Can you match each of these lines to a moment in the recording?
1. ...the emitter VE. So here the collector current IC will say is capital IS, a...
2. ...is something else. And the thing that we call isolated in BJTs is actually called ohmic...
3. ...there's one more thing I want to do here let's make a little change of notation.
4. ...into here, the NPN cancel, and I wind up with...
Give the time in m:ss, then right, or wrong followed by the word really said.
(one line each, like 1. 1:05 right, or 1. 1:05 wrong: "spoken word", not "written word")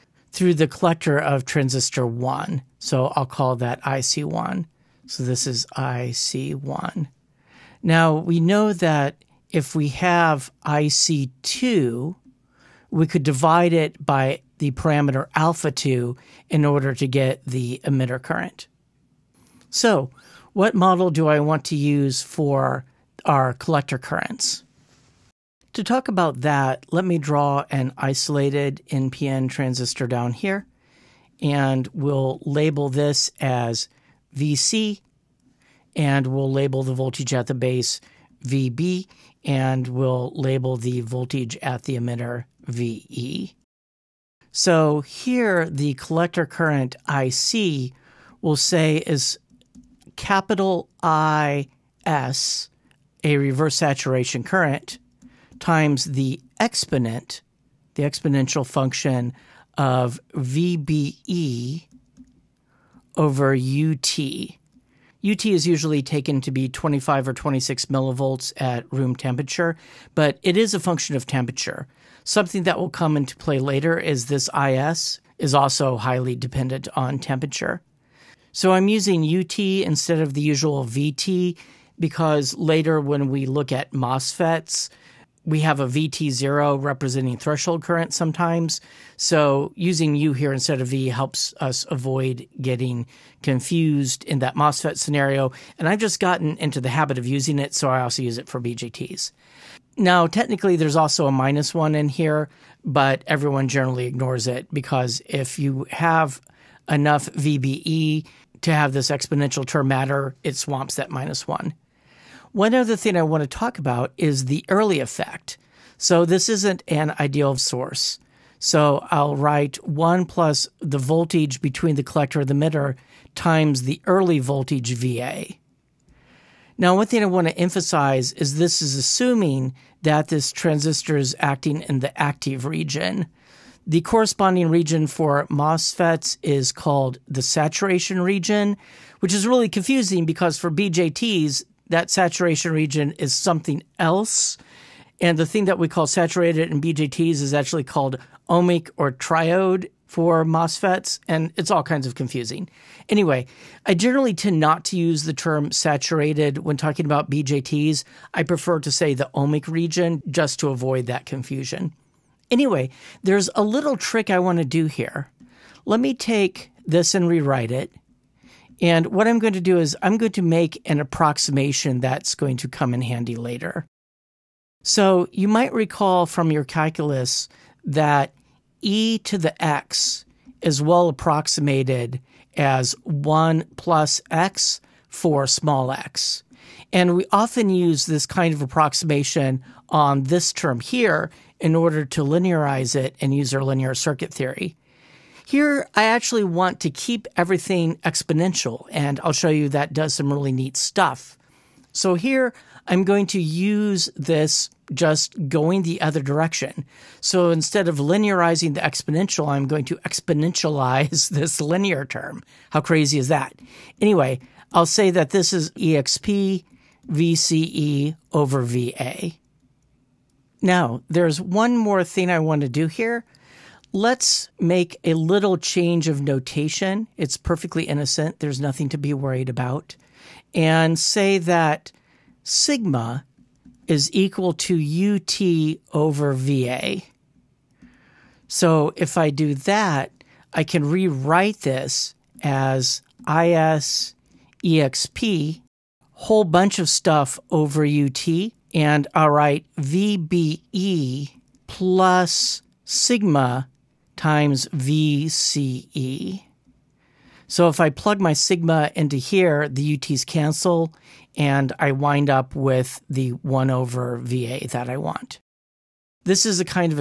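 1. 0:41 right
2. 2:23 wrong: "saturated", not "isolated"
3. 3:41 right
4. 4:18 wrong: "UTs", not "NPN".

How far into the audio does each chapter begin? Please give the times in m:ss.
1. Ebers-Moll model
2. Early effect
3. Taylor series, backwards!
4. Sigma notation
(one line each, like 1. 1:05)
1. 0:19
2. 1:51
3. 2:54
4. 3:43.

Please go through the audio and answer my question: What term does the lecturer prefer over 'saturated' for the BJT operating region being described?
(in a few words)
Ohmic region.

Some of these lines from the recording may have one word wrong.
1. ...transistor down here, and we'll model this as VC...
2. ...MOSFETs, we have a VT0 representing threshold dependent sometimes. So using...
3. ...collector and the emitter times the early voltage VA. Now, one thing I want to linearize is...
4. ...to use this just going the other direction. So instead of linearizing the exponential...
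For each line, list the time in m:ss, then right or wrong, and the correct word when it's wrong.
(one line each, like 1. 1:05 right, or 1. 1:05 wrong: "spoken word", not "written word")
1. 0:29 wrong: "label", not "model"
2. 1:23 wrong: "current", not "dependent"
3. 2:02 wrong: "emphasize", not "linearize"
4. 3:23 right.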